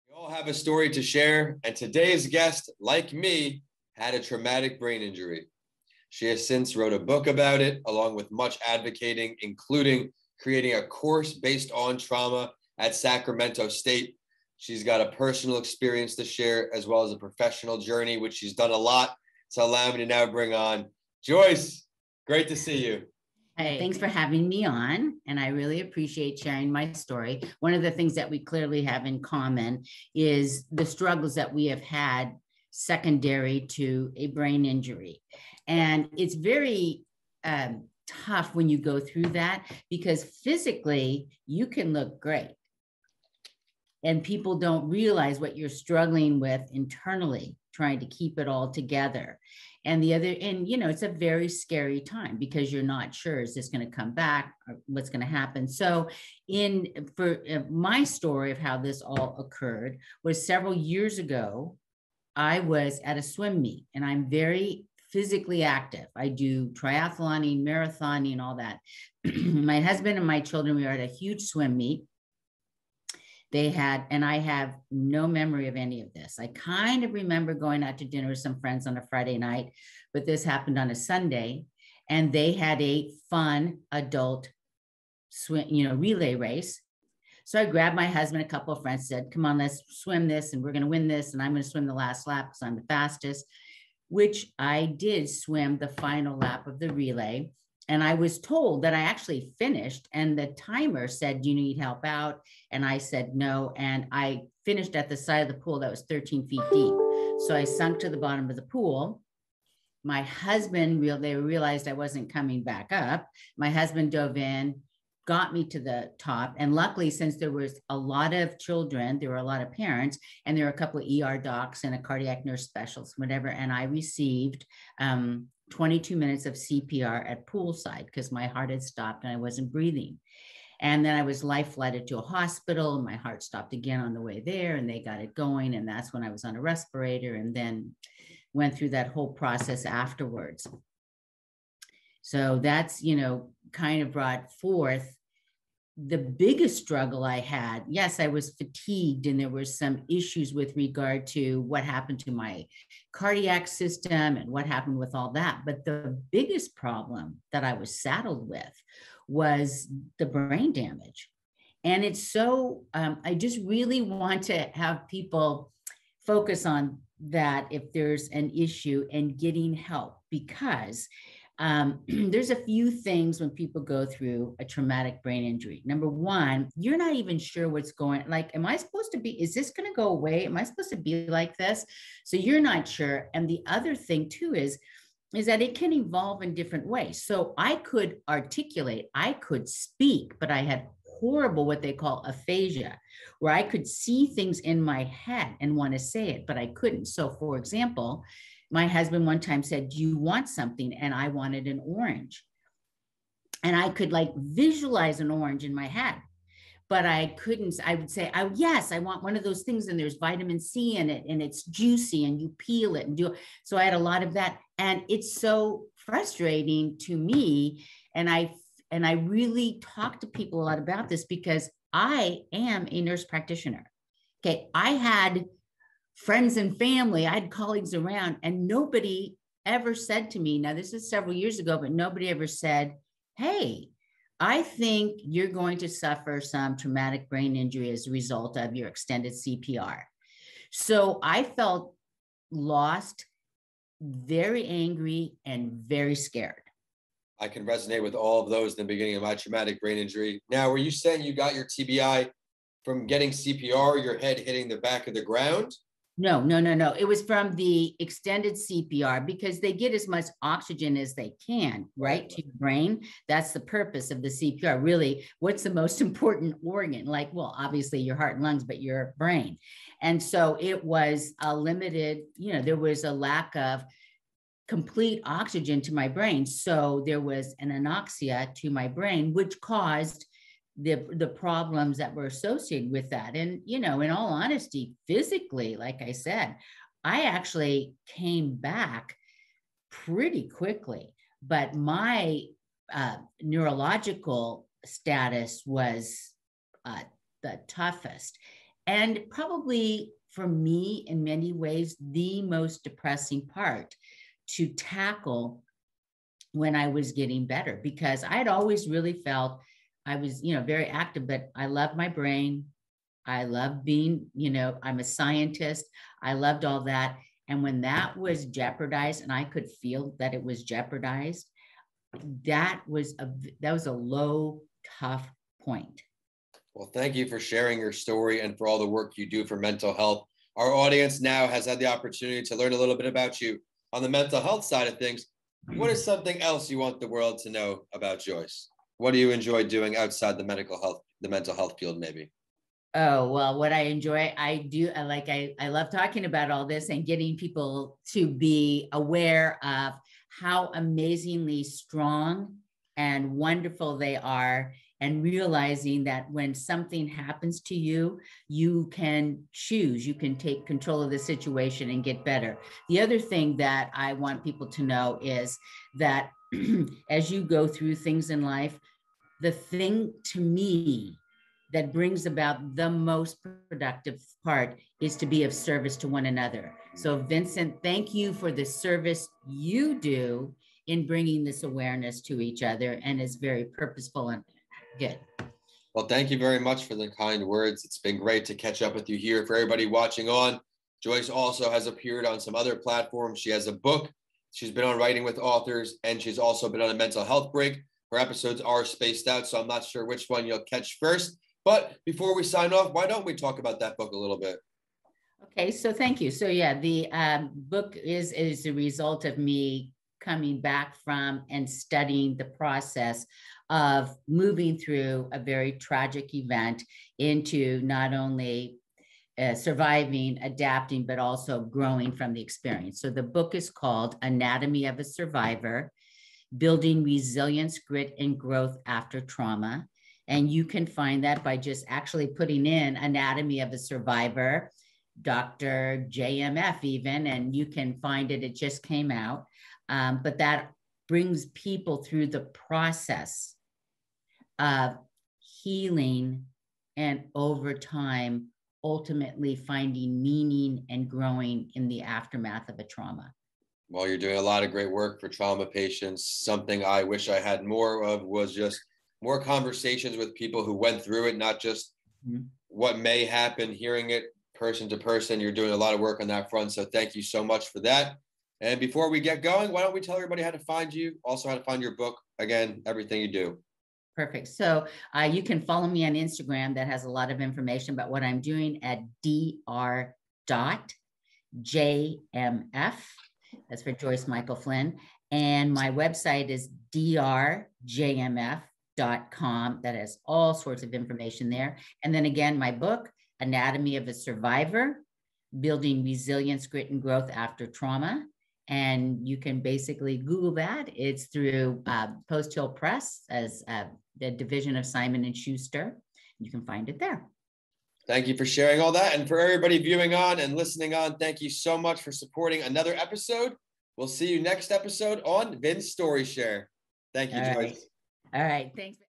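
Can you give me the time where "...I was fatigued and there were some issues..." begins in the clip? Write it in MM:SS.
02:28.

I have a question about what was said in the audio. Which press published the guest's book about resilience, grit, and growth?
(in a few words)
Post Hill Press.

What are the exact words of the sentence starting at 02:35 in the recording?
But the biggest problem that I was saddled with was the brain damage.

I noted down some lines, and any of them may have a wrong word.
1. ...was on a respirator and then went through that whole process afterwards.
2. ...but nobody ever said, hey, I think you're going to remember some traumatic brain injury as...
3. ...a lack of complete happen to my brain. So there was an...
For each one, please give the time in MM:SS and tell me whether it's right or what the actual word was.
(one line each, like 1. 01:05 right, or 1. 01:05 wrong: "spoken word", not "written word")
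1. 02:16 right
2. 03:51 wrong: "suffer", not "remember"
3. 04:33 wrong: "oxygen", not "happen".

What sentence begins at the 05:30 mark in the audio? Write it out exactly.
Our audience now has had the opportunity to learn a little bit about you on the mental health side of things.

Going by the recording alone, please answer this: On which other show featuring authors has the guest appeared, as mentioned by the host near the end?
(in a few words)
Writing with Authors.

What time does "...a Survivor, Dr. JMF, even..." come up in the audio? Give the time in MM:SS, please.
07:13.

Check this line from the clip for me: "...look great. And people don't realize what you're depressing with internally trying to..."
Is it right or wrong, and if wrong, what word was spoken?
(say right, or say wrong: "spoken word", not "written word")
wrong: "struggling", not "depressing".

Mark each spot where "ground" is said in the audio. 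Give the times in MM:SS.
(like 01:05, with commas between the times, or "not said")
04:15.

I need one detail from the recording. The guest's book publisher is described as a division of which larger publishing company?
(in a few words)
Simon and Schuster.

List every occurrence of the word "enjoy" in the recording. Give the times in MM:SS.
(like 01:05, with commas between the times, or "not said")
05:39, 05:43.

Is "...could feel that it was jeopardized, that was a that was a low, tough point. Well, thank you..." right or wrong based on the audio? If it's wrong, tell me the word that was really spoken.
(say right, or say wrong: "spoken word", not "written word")
right.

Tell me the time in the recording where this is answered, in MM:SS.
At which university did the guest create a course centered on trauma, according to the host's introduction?
00:12.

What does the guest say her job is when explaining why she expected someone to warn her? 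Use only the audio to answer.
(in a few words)
Nurse practitioner.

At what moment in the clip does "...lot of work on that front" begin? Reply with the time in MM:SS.
07:45.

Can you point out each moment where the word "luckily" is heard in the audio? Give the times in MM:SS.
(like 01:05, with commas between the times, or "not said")
01:56.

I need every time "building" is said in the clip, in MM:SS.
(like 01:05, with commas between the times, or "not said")
07:06, 08:15.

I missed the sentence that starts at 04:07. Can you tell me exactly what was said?
I can resonate with all of those in the beginning of my traumatic brain injury.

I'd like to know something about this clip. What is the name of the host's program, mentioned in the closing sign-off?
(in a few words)
Vin's Story Share.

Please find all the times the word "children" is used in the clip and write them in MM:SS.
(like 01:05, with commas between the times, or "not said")
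01:10, 01:58.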